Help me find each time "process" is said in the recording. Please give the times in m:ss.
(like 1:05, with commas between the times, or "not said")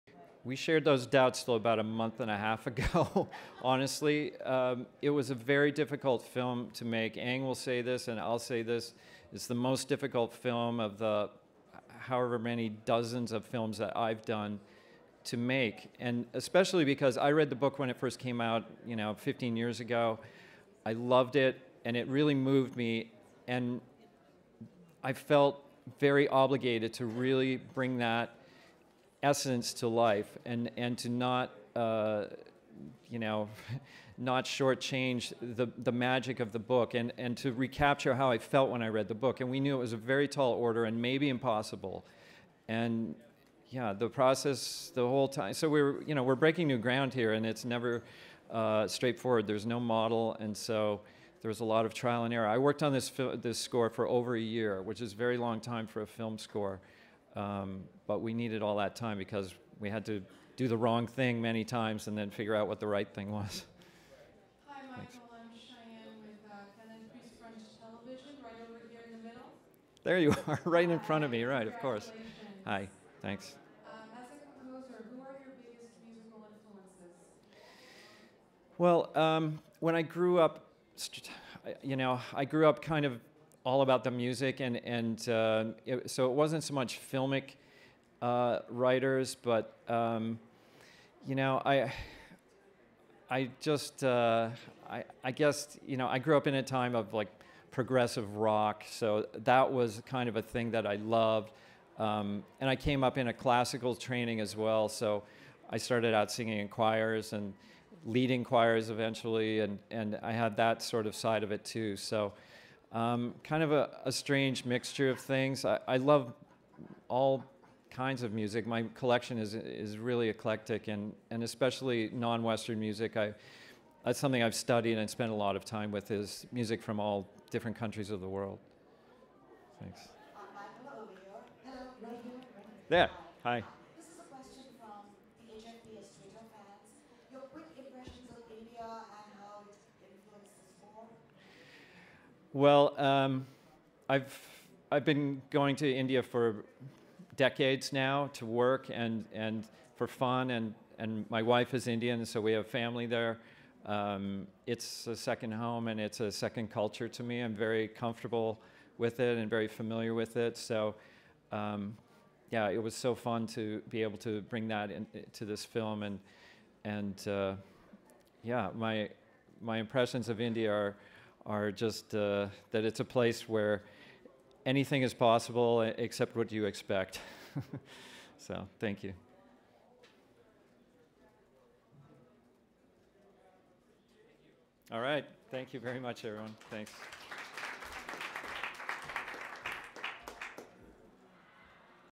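0:44.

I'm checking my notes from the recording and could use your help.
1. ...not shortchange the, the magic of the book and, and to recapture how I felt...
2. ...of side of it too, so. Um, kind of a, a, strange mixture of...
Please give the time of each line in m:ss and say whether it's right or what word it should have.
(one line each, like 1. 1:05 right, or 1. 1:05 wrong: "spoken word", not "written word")
1. 0:34 right
2. 1:51 right.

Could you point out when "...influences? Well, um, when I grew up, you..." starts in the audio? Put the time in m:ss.
1:16.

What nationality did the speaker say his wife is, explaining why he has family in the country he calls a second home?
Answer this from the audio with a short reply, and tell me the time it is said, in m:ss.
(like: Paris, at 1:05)
Indian, at 2:31.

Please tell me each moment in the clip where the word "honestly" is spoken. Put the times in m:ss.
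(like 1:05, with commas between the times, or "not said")
0:03.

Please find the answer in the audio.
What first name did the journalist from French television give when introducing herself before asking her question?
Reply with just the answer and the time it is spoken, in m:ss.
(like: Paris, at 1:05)
Cheyenne, at 1:05.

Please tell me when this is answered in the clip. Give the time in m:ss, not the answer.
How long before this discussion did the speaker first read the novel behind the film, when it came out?
0:19.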